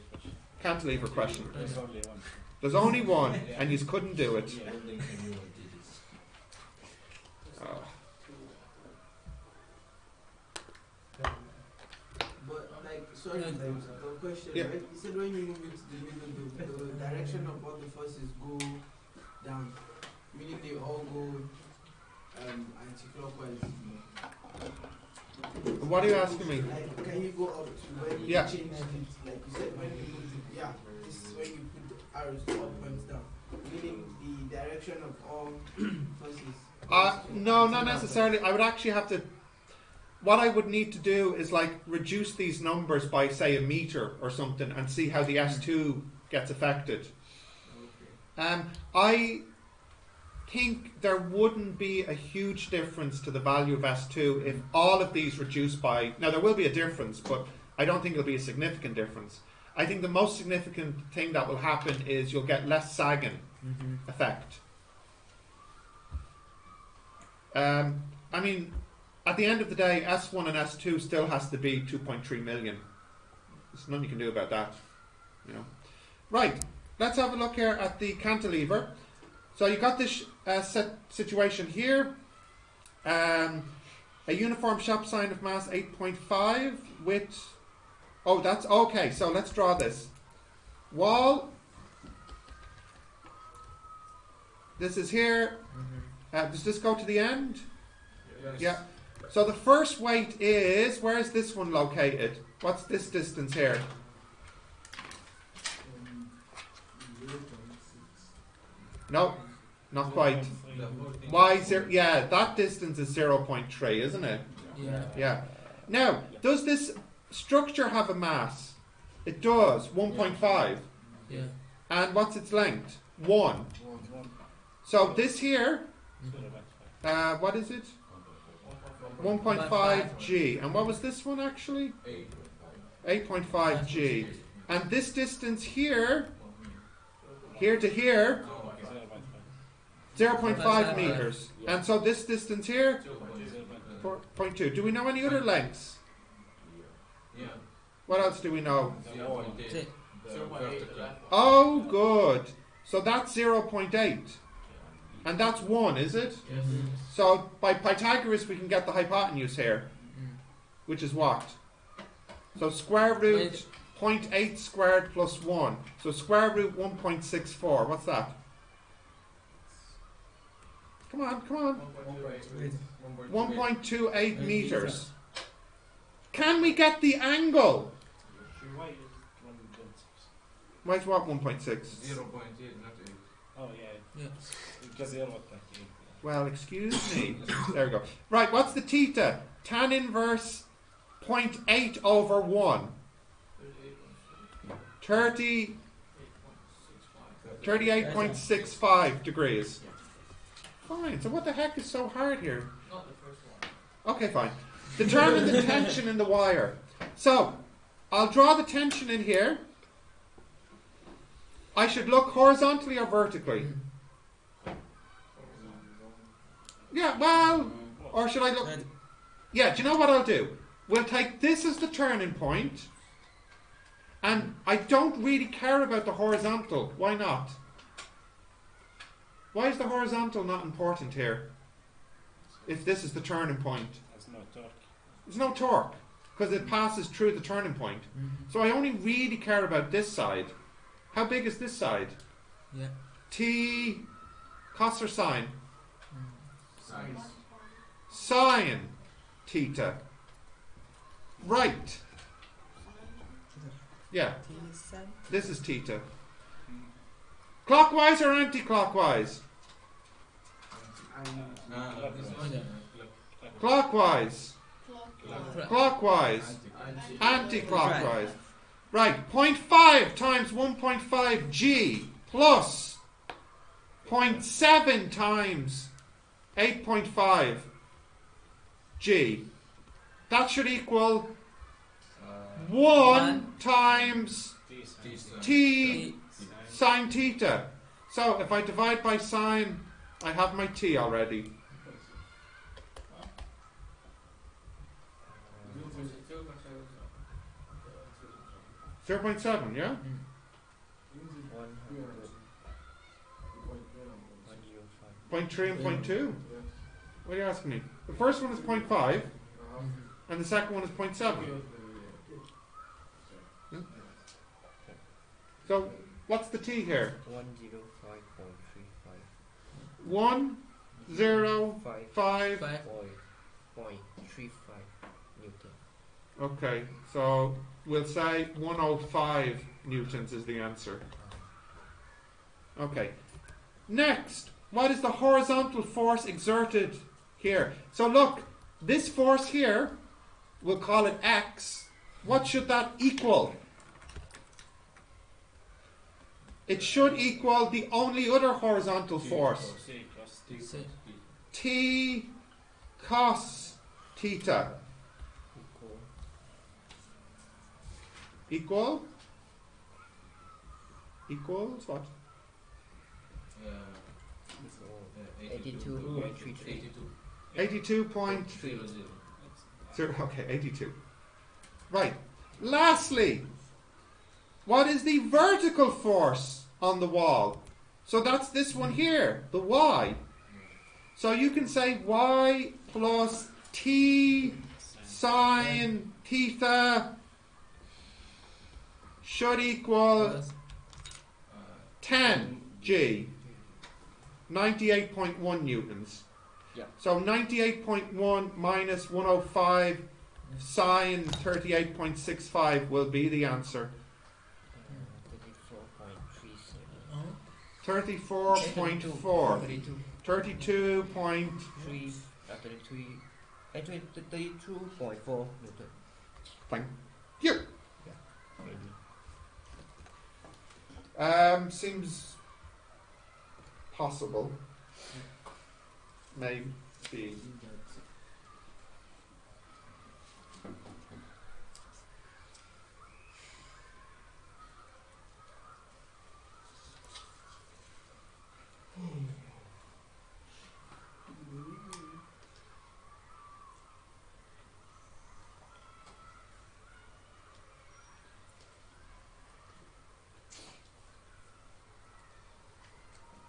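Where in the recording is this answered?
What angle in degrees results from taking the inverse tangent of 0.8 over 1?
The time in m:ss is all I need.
3:17.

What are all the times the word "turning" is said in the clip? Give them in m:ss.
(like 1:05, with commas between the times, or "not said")
3:41, 3:53, 3:57.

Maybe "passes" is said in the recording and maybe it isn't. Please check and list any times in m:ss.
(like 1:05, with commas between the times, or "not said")
3:56.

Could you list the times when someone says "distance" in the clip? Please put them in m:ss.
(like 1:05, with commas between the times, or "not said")
1:43, 1:52, 2:15, 2:22.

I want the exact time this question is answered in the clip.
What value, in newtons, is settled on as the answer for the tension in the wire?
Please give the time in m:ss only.
5:28.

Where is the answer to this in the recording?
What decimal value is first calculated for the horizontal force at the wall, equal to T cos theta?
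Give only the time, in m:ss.
6:05.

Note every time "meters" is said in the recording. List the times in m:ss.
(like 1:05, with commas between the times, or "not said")
0:43, 2:20, 2:54.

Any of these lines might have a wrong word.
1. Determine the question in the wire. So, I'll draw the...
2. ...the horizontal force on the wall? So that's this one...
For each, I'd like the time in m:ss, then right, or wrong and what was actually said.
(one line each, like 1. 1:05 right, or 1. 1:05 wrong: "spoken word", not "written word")
1. 3:24 wrong: "tension", not "question"
2. 6:15 wrong: "vertical", not "horizontal".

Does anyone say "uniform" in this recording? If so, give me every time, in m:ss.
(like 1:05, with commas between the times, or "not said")
1:24.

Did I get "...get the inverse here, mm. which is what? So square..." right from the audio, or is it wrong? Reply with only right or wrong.
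wrong.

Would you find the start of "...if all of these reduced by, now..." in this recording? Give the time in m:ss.
0:54.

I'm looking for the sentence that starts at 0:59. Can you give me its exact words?
I think the most significant thing that will happen is you'll get less sagging mm -hmm.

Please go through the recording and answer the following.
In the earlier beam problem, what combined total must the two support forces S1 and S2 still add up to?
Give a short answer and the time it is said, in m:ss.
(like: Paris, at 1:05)
2.3 million, at 1:11.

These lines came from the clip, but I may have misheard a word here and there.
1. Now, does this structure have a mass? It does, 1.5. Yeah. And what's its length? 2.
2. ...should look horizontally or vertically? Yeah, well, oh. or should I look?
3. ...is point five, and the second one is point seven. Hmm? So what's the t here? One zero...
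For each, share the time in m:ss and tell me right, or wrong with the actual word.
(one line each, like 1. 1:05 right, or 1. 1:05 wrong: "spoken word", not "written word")
1. 1:55 wrong: "1", not "2"
2. 3:31 right
3. 5:08 right.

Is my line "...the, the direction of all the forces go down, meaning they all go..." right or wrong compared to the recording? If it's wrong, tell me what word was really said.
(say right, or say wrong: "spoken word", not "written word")
right.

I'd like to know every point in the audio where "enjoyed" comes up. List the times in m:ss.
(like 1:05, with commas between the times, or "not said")
not said.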